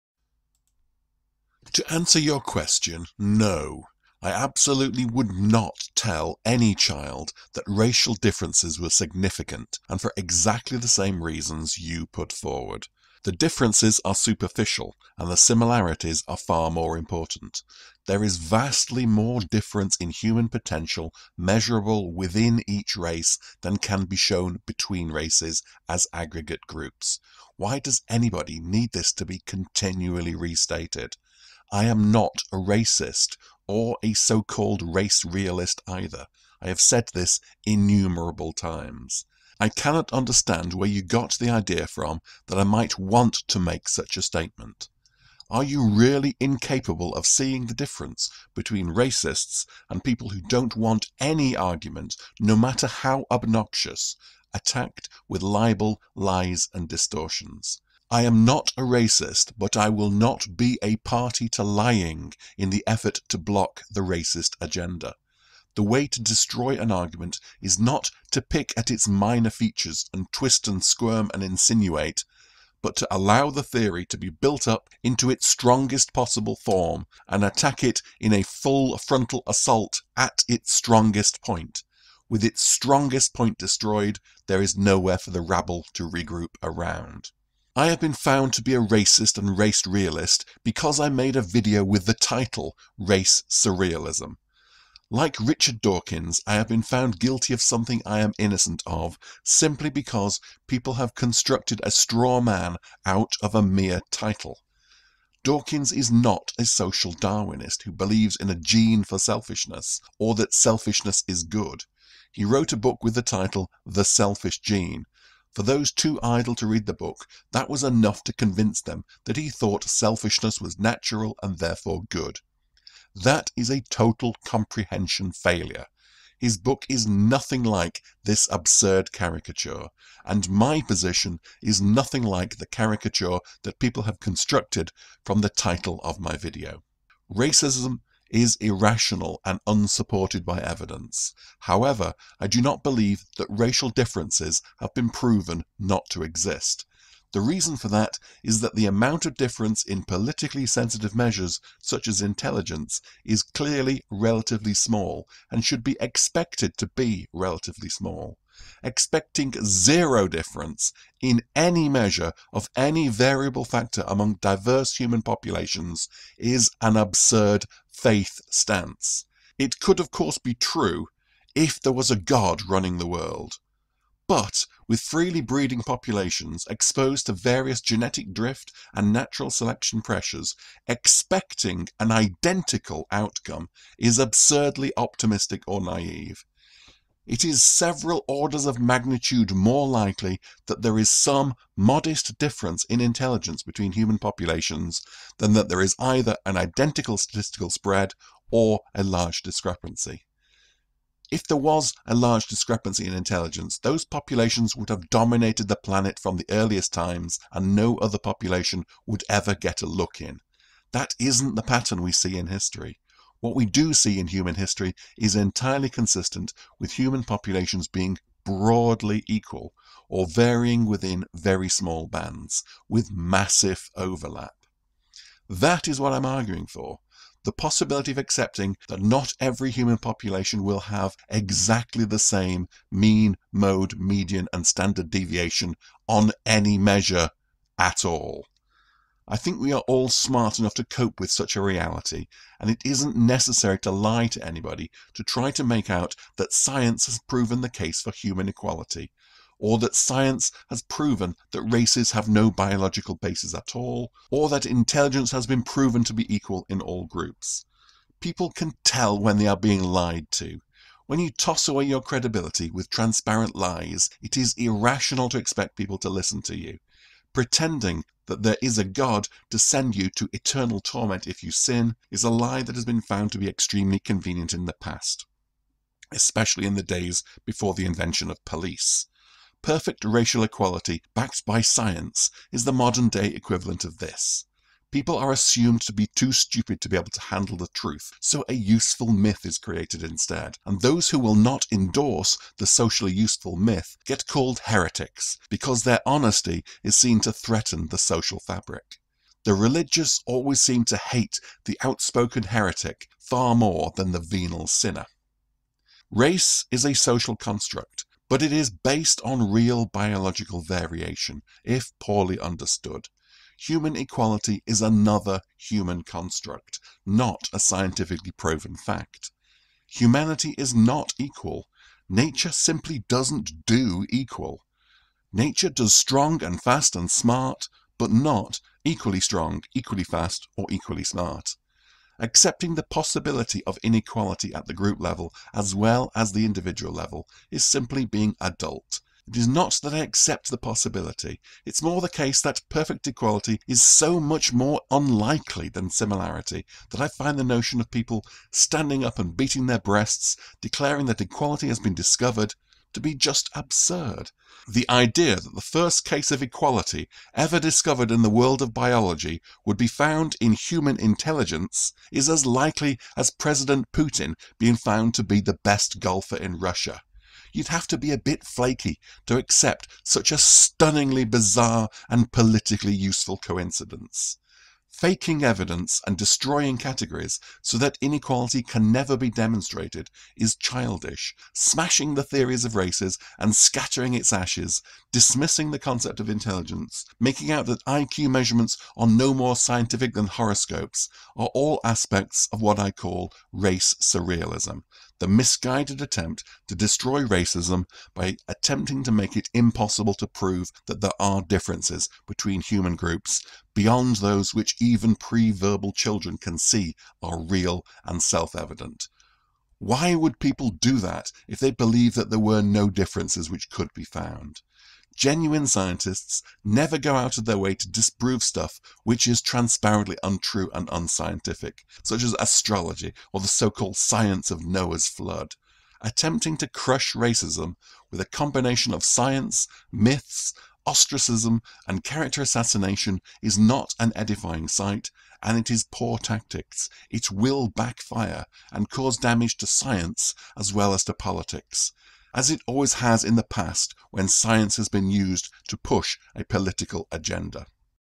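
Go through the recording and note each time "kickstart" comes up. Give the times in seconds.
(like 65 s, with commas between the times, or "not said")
not said.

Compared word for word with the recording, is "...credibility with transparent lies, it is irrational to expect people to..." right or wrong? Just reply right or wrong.
right.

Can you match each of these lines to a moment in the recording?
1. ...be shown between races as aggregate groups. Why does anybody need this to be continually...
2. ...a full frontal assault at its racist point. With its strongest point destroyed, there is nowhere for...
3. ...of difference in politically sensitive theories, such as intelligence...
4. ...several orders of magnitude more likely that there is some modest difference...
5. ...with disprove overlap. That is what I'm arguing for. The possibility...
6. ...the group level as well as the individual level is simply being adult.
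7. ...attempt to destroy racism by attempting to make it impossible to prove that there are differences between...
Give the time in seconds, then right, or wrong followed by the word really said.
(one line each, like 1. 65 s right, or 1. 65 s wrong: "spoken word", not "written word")
1. 24 s right
2. 78 s wrong: "strongest", not "racist"
3. 149 s wrong: "measures", not "theories"
4. 187 s right
5. 222 s wrong: "massive", not "disprove"
6. 334 s right
7. 396 s right.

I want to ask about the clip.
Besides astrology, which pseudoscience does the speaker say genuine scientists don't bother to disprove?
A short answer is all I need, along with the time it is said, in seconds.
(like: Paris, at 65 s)
Noah's flood, at 424 s.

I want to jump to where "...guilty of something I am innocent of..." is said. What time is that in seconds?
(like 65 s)
97 s.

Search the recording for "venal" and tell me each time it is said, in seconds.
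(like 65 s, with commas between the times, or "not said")
304 s.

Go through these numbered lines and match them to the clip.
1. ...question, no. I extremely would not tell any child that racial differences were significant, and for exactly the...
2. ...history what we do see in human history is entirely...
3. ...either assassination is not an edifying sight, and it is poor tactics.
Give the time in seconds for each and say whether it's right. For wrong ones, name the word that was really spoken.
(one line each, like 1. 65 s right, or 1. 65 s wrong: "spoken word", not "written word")
1. 2 s wrong: "absolutely", not "extremely"
2. 212 s right
3. 432 s wrong: "character", not "either".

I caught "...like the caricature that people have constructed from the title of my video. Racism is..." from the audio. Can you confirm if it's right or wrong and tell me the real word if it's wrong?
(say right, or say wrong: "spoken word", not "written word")
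right.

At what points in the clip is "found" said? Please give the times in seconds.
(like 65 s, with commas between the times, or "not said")
88 s, 96 s, 273 s, 359 s, 364 s, 414 s.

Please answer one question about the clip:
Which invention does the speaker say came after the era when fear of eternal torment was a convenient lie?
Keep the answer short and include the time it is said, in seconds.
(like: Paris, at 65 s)
police, at 278 s.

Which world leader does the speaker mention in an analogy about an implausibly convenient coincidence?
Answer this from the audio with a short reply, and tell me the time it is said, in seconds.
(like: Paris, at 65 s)
President Putin, at 363 s.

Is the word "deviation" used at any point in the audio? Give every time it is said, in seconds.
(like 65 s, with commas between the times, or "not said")
235 s.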